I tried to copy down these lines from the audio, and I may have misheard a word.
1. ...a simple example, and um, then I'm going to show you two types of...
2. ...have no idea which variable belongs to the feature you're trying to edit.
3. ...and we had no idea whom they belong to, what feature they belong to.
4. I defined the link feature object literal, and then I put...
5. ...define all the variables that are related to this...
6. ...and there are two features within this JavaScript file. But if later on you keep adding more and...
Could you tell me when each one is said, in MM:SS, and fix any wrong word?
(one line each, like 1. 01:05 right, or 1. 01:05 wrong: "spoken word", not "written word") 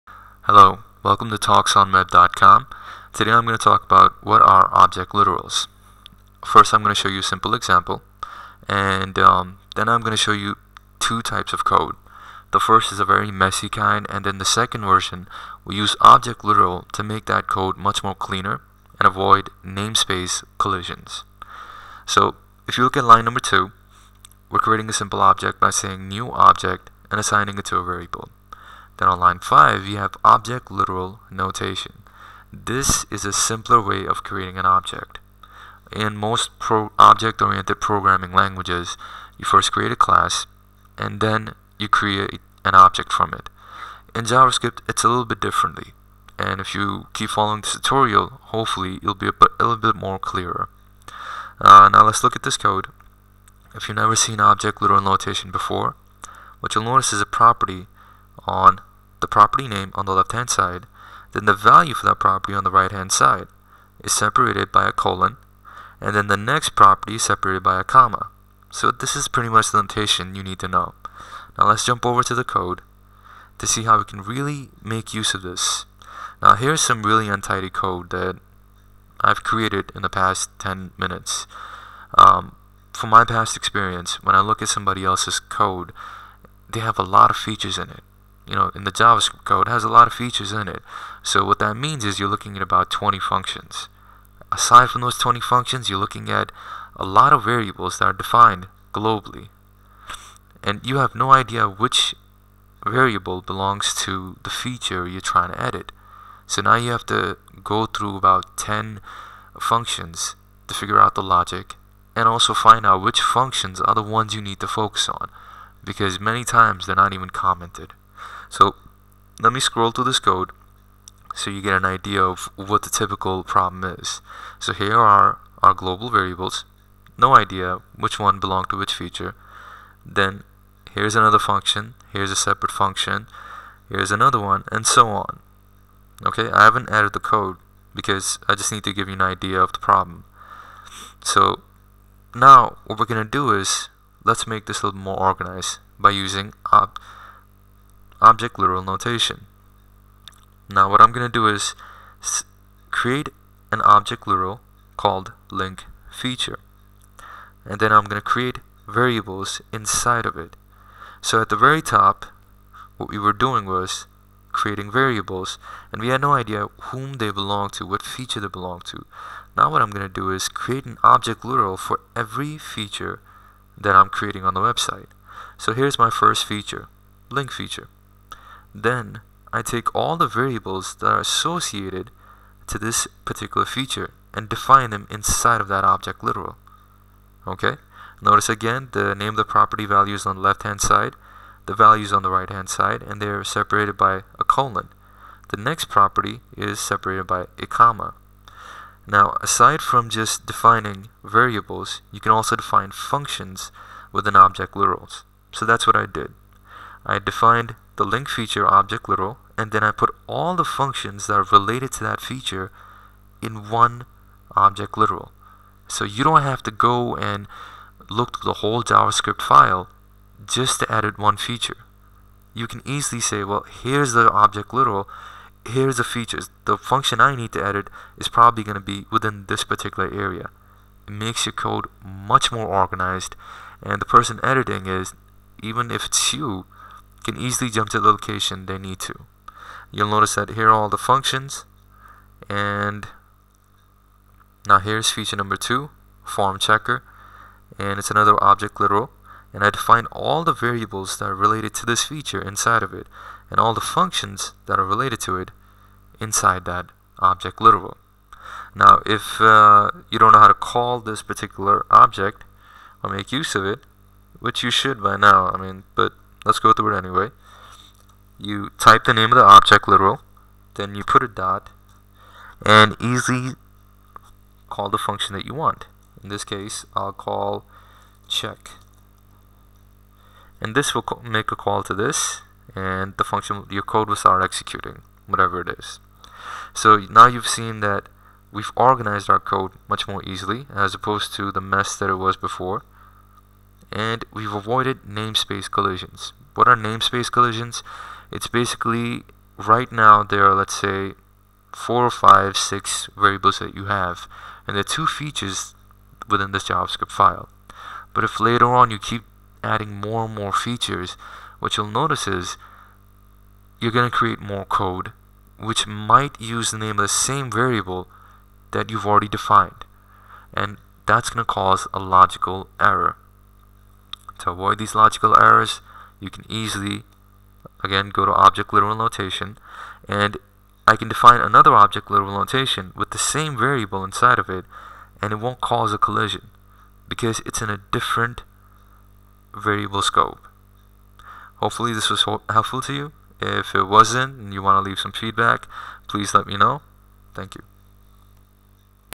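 1. 00:07 right
2. 01:40 right
3. 02:45 right
4. 03:27 right
5. 04:09 right
6. 05:04 right.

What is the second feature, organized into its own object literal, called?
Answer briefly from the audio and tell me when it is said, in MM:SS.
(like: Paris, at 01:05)
form checker, at 04:06.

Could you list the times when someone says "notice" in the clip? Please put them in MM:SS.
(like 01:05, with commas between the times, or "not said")
00:56, 03:08, 04:00, 05:11.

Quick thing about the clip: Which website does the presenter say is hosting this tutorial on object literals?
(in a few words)
Talks on Web.com.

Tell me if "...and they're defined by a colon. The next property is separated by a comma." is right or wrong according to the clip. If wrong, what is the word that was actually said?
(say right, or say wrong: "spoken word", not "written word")
wrong: "separated", not "defined".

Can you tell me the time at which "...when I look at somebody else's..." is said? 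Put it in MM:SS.
01:24.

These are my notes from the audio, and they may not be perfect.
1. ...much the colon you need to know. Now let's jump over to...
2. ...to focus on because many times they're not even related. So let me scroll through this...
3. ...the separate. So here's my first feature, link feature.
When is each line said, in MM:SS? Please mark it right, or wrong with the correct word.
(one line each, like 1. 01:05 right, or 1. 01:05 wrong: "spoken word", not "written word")
1. 01:09 wrong: "notation", not "colon"
2. 01:54 wrong: "commented", not "related"
3. 02:54 wrong: "website", not "separate".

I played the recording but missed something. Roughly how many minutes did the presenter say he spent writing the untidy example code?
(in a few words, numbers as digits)
10.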